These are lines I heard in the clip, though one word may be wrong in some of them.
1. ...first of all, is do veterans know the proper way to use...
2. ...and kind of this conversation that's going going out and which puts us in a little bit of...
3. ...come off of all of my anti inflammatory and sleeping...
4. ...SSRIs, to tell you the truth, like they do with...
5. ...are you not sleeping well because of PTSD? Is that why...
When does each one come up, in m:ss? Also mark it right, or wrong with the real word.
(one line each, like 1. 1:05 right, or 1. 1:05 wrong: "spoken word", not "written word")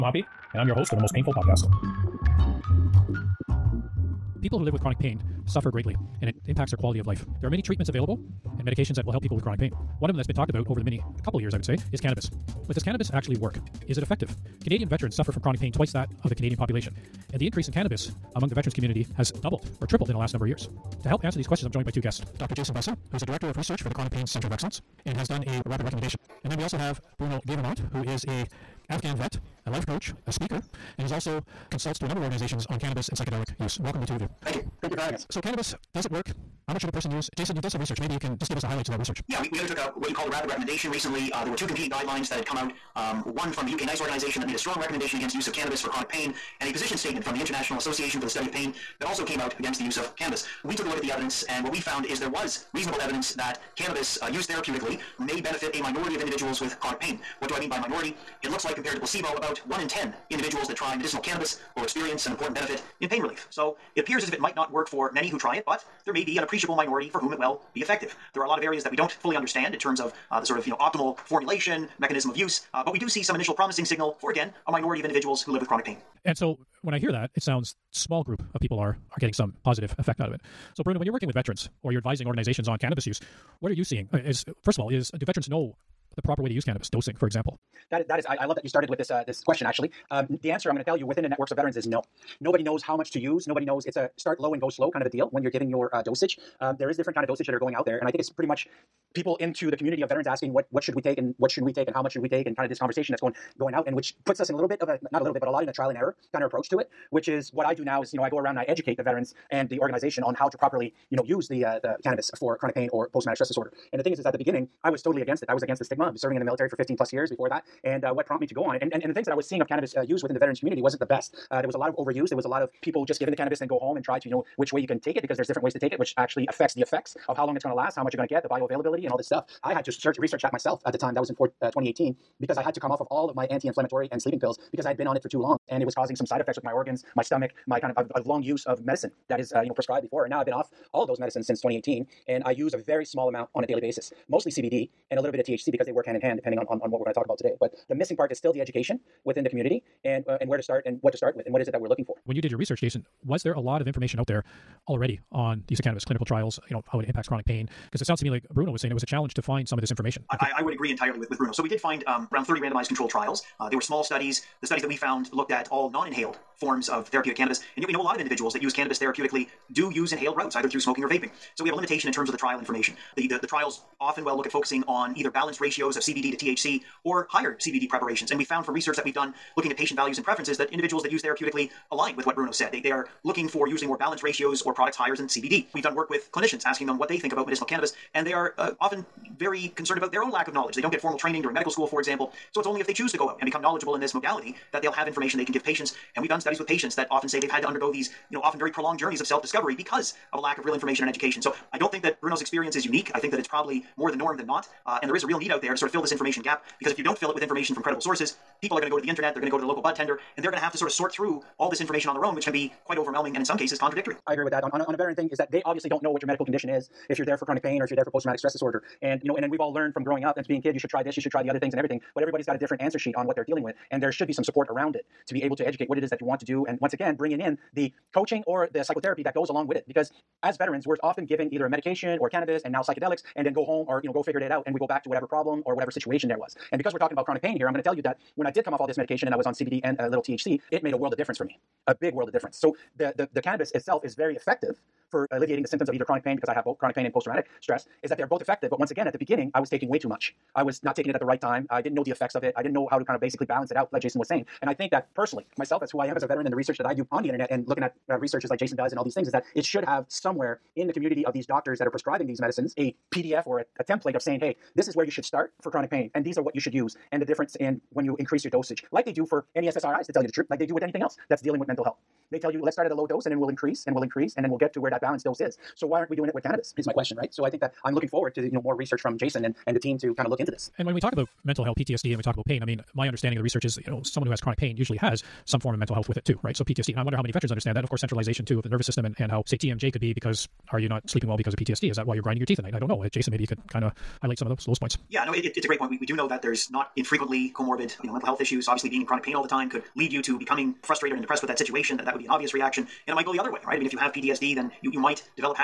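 1. 1:24 right
2. 1:42 right
3. 2:12 right
4. 4:29 right
5. 4:50 right.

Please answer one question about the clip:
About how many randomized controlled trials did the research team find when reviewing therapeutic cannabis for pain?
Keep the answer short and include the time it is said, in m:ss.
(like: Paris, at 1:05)
30, at 2:42.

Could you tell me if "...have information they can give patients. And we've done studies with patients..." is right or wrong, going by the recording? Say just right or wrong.
right.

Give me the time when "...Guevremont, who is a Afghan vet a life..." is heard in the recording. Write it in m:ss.
0:27.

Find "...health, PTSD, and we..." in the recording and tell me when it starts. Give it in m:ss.
4:41.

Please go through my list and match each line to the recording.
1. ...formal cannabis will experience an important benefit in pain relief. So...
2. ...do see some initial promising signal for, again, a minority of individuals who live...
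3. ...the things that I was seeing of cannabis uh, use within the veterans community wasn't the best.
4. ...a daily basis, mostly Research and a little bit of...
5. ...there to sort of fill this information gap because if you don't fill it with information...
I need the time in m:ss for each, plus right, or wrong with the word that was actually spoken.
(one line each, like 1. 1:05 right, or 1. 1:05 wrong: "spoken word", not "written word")
1. 1:00 wrong: "medicinal", not "formal"
2. 1:12 right
3. 1:59 right
4. 2:23 wrong: "CBD", not "Research"
5. 3:25 right.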